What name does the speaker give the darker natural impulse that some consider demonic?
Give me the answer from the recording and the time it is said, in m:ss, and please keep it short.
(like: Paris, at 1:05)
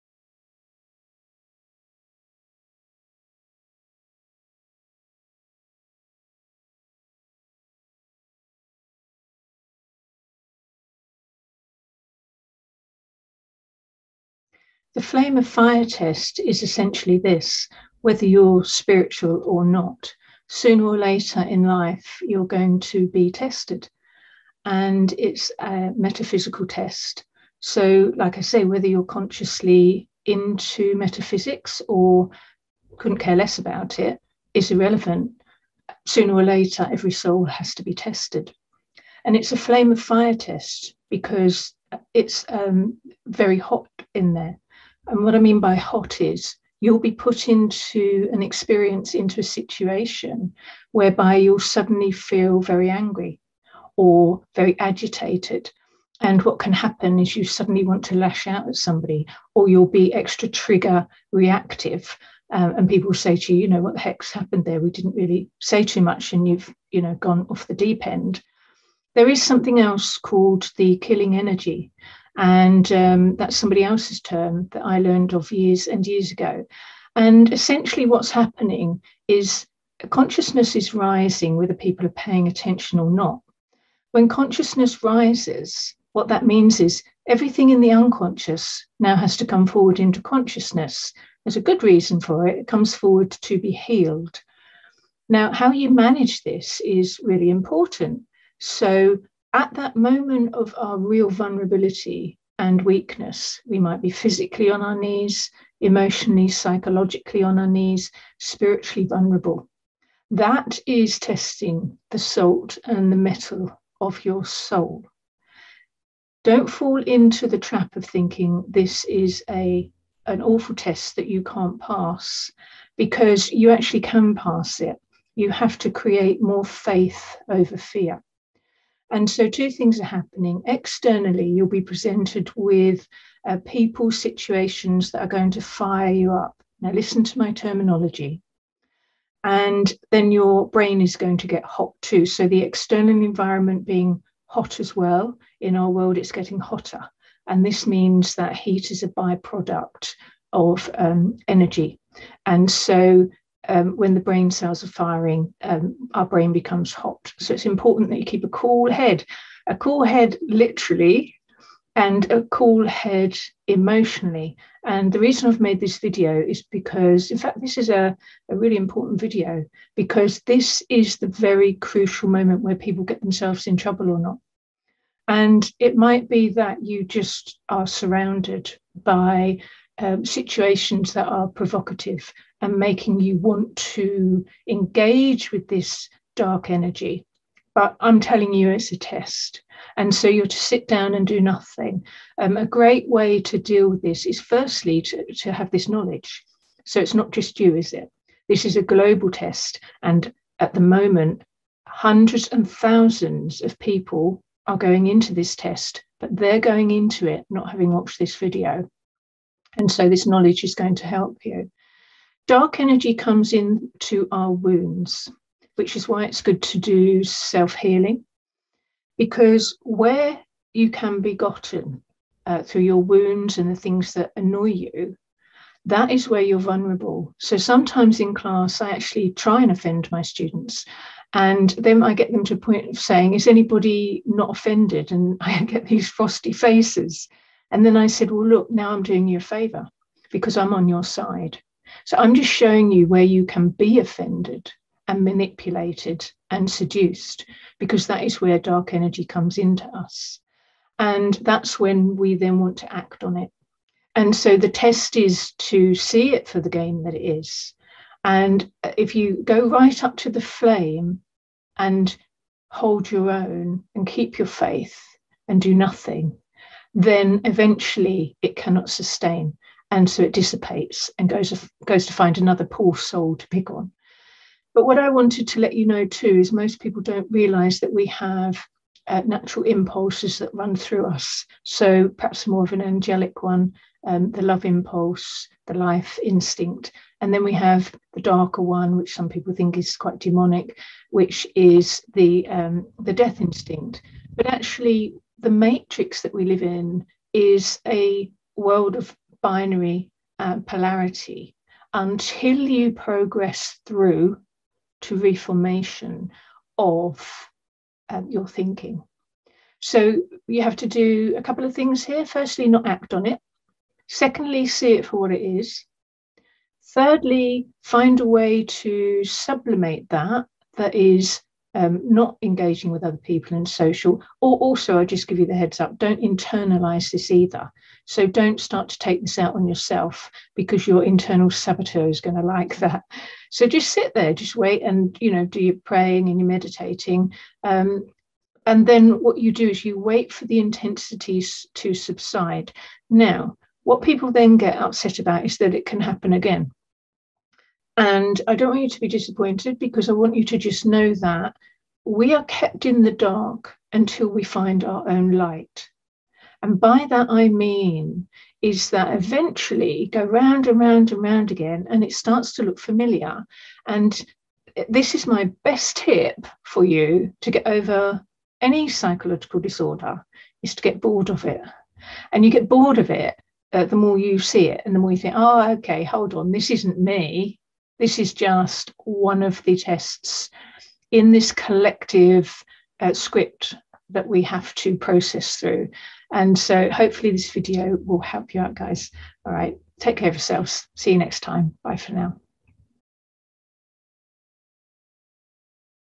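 death instinct, at 4:53.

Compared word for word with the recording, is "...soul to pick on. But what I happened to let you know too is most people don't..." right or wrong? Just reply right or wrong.
wrong.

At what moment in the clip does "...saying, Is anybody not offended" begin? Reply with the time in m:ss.
3:52.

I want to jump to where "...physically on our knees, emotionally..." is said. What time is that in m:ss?
1:44.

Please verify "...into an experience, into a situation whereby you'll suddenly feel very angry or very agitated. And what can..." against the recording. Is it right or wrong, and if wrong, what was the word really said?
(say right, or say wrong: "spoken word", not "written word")
right.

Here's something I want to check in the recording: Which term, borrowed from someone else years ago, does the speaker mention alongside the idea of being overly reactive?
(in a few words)
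killing energy.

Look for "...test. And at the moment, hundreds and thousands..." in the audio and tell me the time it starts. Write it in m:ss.
3:19.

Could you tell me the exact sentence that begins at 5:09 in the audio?
So you have to do a couple of things here.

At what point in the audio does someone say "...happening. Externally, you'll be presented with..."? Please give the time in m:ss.
2:10.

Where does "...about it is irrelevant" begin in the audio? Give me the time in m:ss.
0:33.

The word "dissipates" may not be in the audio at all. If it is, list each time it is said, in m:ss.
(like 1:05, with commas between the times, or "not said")
4:30.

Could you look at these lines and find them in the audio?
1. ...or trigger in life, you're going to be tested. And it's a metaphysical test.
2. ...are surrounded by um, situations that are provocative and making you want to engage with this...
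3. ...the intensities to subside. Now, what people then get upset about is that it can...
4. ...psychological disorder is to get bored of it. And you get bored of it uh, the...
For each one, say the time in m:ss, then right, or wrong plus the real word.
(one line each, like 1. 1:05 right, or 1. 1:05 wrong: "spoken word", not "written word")
1. 0:20 wrong: "later", not "trigger"
2. 2:57 right
3. 5:40 right
4. 6:08 right.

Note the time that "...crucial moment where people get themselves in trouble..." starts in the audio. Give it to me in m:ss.
2:51.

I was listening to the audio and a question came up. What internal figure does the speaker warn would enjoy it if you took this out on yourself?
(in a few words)
internal saboteur.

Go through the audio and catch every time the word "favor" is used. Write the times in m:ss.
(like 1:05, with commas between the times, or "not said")
3:59.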